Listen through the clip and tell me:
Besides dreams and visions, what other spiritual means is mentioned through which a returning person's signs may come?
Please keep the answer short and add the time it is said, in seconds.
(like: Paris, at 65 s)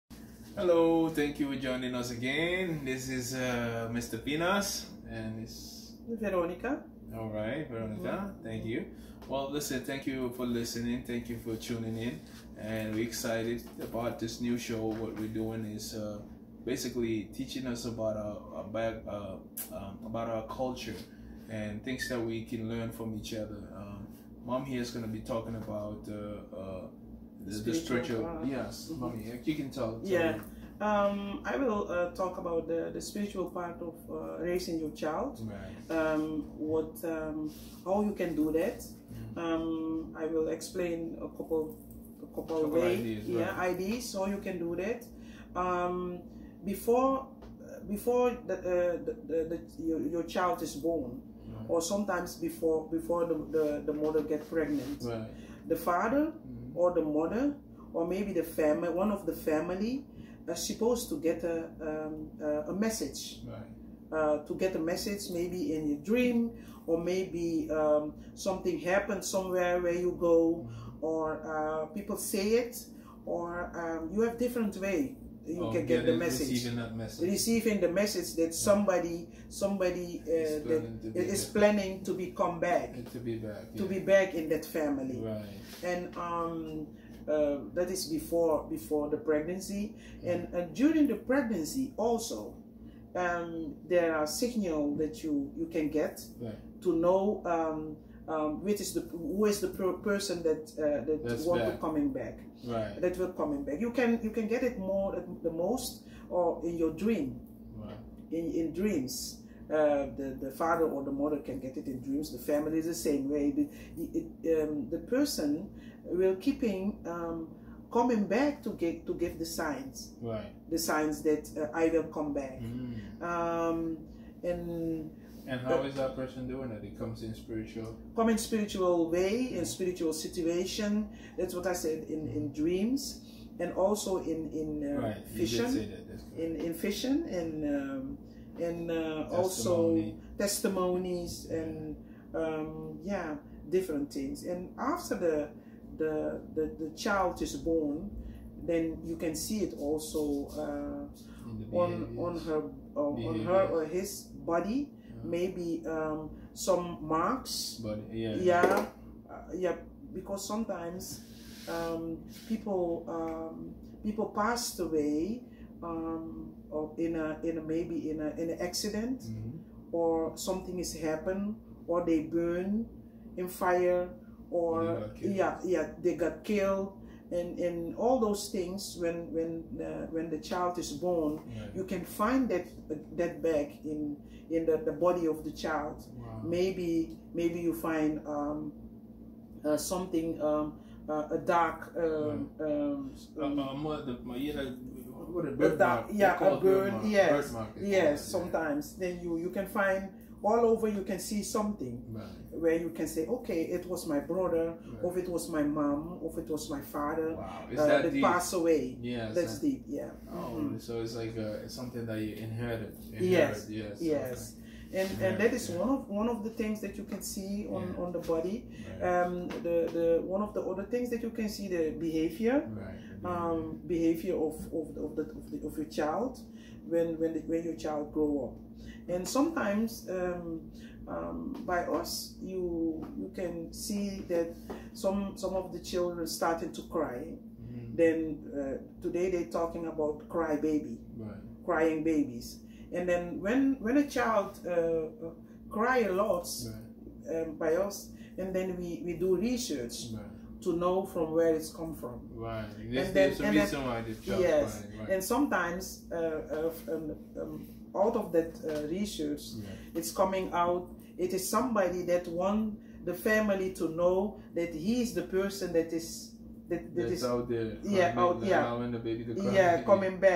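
Testimonies, at 140 s.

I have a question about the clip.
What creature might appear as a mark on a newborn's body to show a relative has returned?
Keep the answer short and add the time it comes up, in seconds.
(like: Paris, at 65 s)
A bird, at 196 s.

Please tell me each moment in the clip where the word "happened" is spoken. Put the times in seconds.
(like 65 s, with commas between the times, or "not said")
68 s, 170 s.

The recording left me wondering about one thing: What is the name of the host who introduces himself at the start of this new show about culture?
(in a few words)
Mr. Pinas.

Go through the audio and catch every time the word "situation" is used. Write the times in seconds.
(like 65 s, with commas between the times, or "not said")
130 s.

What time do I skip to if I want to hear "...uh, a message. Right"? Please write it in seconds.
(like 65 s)
62 s.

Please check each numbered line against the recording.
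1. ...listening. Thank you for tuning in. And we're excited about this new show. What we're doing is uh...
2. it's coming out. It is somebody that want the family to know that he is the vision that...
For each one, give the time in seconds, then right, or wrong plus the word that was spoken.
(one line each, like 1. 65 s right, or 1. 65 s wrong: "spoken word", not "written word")
1. 10 s right
2. 259 s wrong: "person", not "vision".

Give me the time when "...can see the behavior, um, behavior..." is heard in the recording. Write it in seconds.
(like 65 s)
221 s.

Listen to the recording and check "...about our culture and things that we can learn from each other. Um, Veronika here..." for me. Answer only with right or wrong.
wrong.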